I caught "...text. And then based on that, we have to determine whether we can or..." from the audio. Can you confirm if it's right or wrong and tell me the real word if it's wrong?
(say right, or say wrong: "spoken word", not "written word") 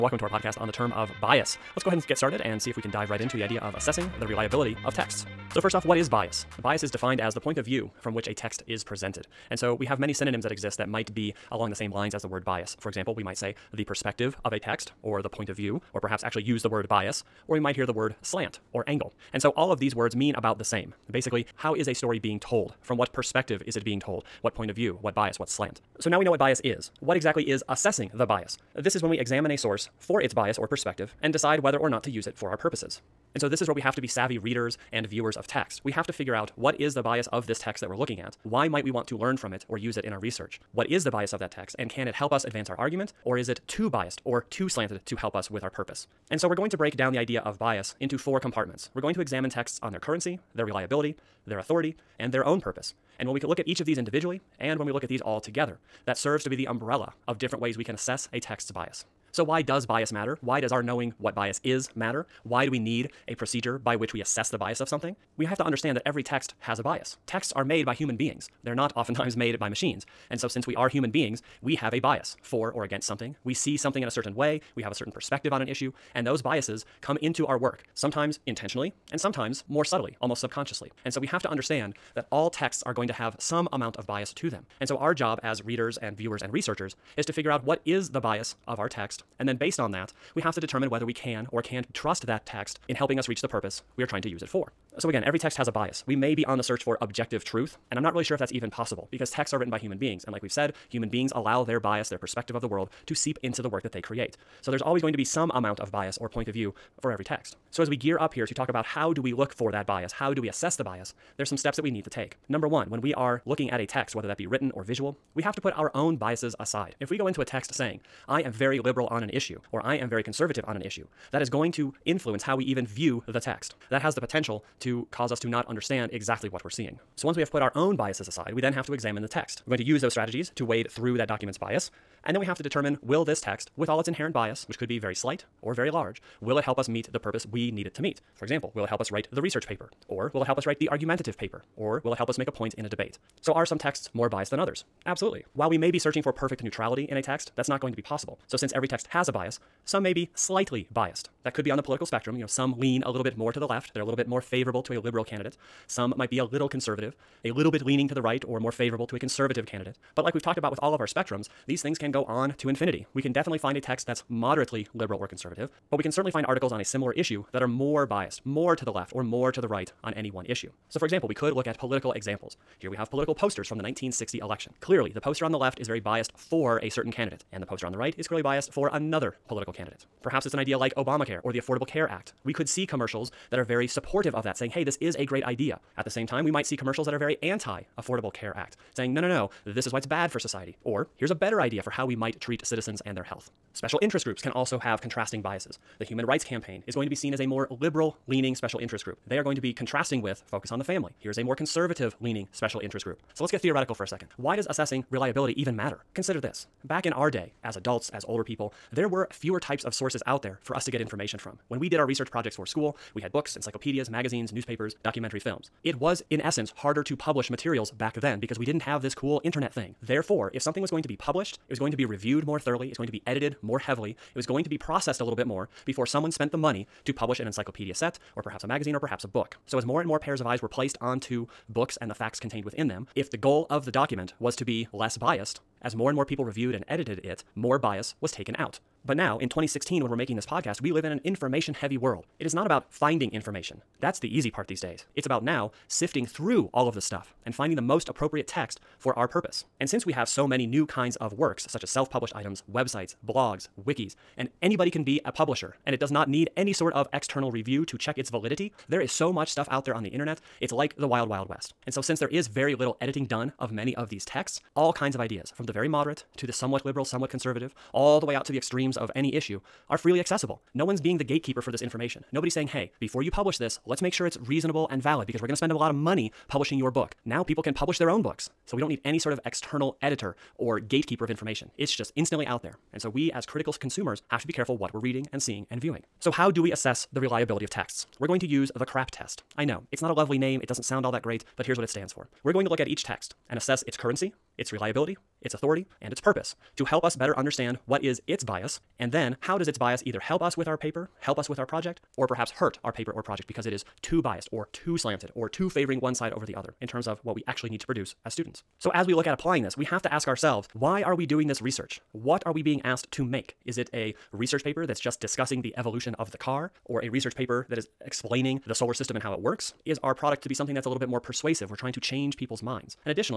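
right.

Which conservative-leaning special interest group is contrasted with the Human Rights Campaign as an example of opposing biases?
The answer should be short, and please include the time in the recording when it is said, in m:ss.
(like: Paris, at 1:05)
Focus on the Family, at 3:20.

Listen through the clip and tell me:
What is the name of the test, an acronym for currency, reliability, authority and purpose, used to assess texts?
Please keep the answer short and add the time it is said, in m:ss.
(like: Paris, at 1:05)
CRAP test, at 4:48.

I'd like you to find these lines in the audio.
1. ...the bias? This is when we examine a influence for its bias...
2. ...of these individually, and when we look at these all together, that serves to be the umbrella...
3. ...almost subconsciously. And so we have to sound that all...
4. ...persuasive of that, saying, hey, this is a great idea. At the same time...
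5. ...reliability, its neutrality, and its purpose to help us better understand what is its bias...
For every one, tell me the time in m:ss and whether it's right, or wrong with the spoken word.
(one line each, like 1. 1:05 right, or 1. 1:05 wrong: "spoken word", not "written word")
1. 0:28 wrong: "source", not "influence"
2. 0:53 right
3. 1:20 wrong: "understand", not "sound"
4. 3:03 wrong: "supportive", not "persuasive"
5. 4:54 wrong: "authority", not "neutrality".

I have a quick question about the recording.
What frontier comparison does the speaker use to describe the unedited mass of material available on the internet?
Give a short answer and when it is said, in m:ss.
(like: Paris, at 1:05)
wild, wild west, at 4:21.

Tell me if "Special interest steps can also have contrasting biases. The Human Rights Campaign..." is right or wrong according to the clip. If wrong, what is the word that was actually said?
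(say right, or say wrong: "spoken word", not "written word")
wrong: "groups", not "steps".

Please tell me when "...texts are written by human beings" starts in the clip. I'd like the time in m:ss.
1:39.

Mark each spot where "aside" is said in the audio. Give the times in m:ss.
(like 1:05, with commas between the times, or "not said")
1:56, 2:08.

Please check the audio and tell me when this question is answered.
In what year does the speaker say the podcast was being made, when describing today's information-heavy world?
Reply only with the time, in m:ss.
3:59.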